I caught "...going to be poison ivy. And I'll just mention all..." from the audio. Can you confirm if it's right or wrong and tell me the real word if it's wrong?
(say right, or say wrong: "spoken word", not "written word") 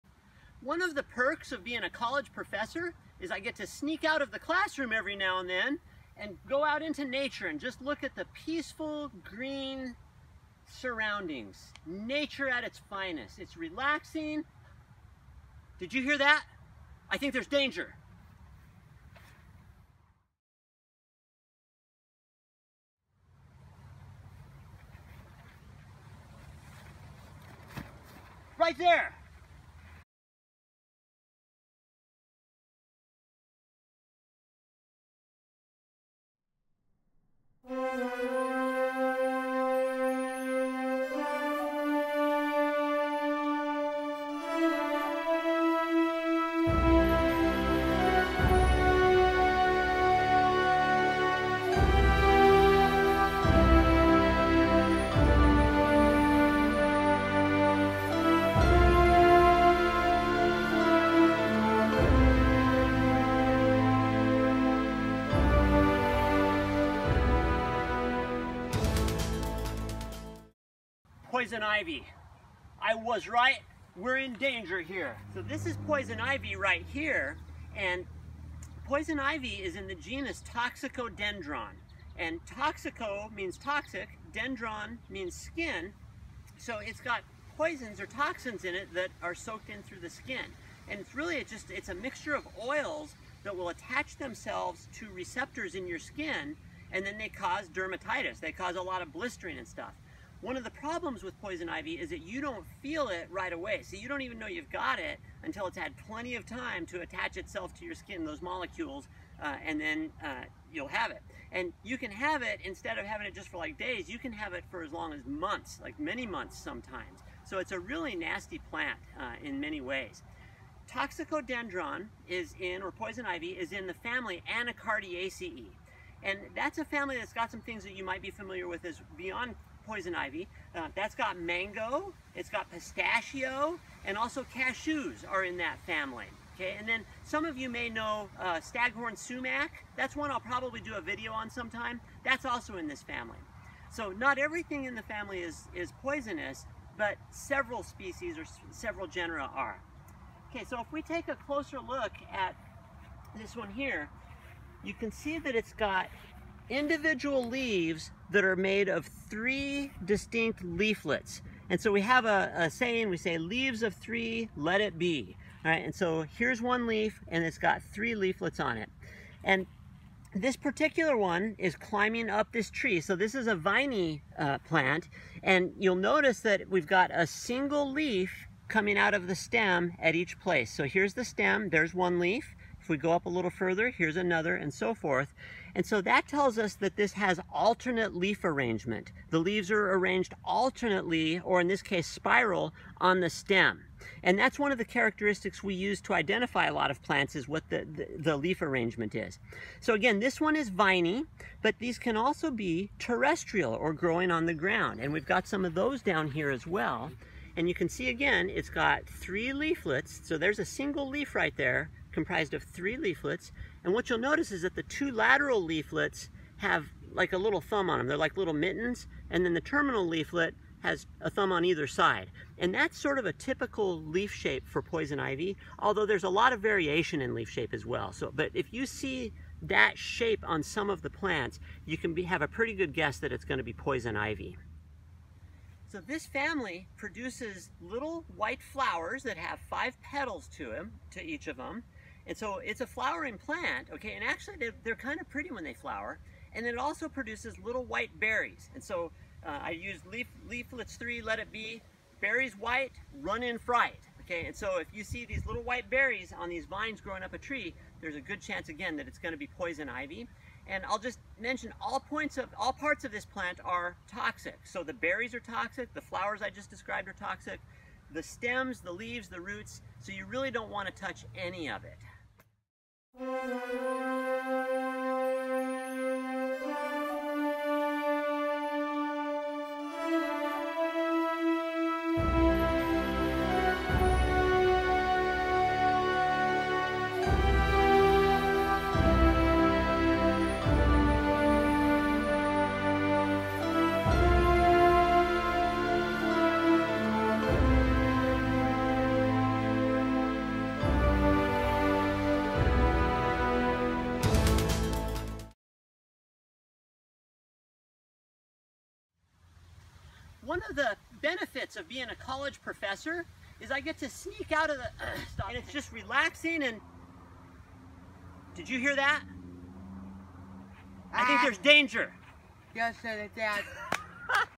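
right.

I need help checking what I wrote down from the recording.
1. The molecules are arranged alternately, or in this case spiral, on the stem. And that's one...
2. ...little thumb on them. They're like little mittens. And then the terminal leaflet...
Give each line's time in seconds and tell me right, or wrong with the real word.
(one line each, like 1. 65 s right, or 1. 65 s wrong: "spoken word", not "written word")
1. 189 s wrong: "leaves", not "molecules"
2. 217 s right.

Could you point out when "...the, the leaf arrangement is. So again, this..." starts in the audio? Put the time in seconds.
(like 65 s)
197 s.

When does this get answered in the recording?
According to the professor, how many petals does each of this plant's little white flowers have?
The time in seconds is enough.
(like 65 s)
239 s.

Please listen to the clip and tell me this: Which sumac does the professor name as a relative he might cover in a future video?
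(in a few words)
Staghorn sumac.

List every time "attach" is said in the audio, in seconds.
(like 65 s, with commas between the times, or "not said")
93 s, 107 s.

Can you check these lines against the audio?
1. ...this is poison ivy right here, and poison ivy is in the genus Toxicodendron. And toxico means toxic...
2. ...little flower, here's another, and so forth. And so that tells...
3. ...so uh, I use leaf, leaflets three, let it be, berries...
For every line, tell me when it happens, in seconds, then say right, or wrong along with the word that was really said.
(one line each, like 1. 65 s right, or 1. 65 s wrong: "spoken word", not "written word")
1. 75 s right
2. 183 s wrong: "further", not "flower"
3. 248 s right.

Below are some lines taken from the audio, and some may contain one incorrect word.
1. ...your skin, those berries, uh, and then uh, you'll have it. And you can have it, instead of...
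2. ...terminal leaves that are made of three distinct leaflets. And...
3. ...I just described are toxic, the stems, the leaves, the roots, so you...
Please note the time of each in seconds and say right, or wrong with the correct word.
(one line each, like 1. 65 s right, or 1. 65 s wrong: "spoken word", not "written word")
1. 107 s wrong: "molecules", not "berries"
2. 156 s wrong: "individual", not "terminal"
3. 266 s right.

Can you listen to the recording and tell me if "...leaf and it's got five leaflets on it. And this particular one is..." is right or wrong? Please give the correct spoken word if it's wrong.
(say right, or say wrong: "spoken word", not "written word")
wrong: "three", not "five".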